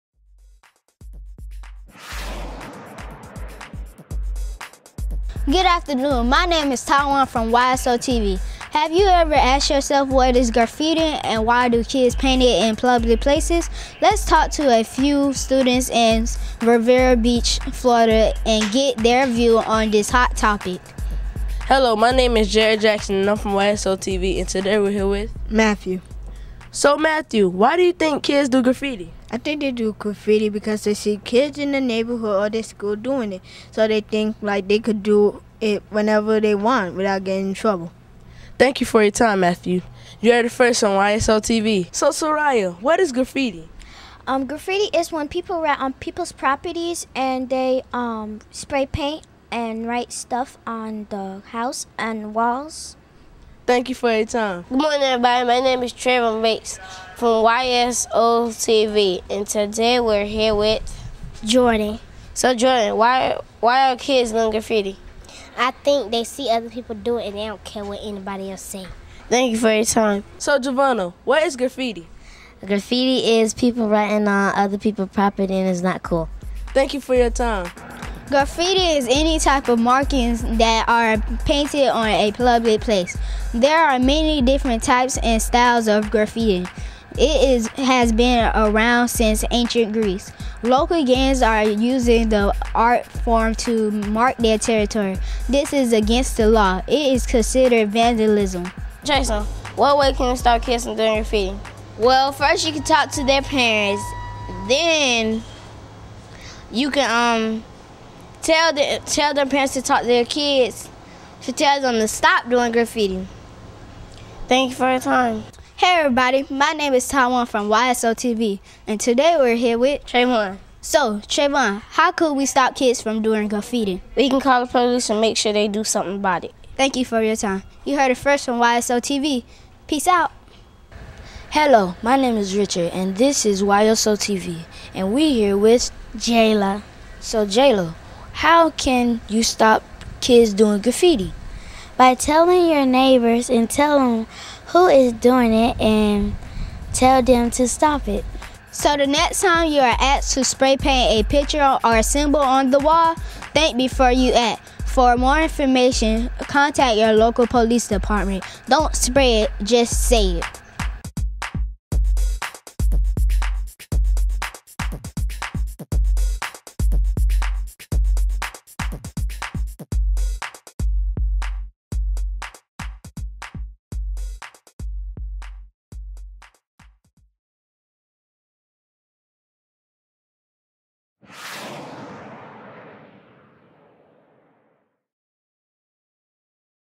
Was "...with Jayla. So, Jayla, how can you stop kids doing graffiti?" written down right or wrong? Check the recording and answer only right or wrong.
right.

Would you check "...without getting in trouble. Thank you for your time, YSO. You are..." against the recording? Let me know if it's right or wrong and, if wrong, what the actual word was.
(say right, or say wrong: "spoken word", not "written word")
wrong: "Matthew", not "YSO".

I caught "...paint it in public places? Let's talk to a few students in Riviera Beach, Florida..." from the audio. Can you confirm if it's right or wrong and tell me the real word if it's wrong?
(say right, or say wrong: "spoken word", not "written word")
right.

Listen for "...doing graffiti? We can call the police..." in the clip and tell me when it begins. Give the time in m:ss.
2:03.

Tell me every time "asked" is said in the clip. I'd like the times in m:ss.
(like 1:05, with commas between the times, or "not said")
0:09, 2:29.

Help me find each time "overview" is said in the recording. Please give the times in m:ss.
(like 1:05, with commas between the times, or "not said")
not said.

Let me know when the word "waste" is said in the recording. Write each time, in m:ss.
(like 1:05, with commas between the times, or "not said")
not said.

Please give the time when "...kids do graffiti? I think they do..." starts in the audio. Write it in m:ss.
0:28.